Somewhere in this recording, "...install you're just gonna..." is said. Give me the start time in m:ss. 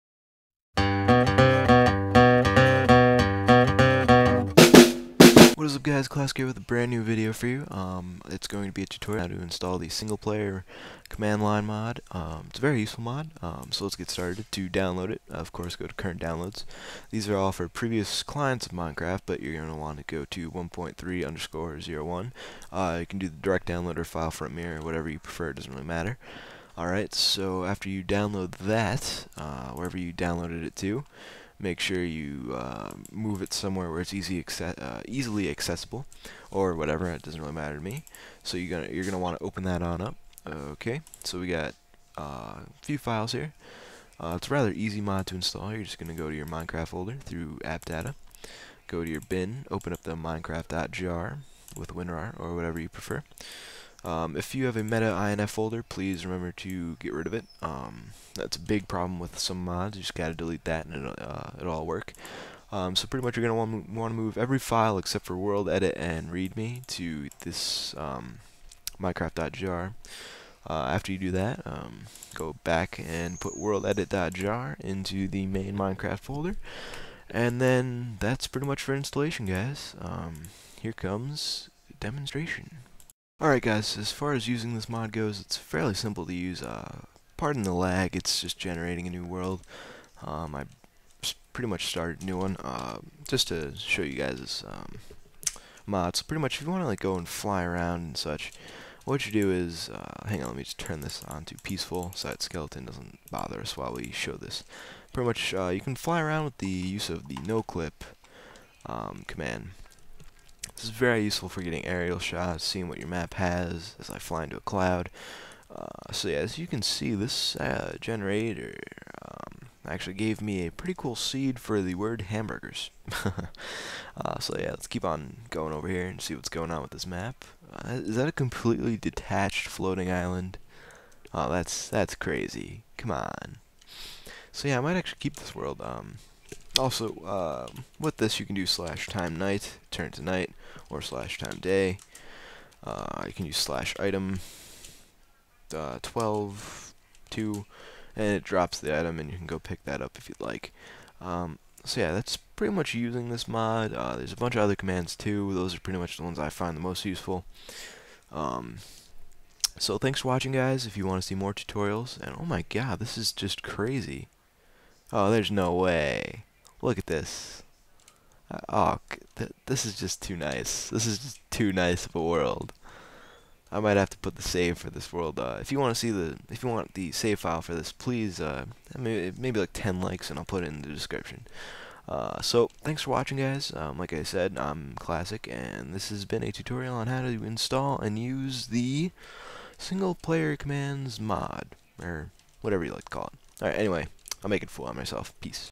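0:45.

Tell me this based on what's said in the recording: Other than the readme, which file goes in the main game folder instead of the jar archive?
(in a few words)
WorldEdit.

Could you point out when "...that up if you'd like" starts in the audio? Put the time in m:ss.
2:29.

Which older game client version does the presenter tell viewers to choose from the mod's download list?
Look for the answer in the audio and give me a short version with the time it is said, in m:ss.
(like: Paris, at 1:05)
1.3_01, at 0:20.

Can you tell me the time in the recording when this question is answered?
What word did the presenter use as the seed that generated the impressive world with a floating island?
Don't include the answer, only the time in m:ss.
2:02.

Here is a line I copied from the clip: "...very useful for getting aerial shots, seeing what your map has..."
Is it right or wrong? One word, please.
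right.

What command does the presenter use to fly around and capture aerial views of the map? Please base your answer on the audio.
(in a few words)
noclip.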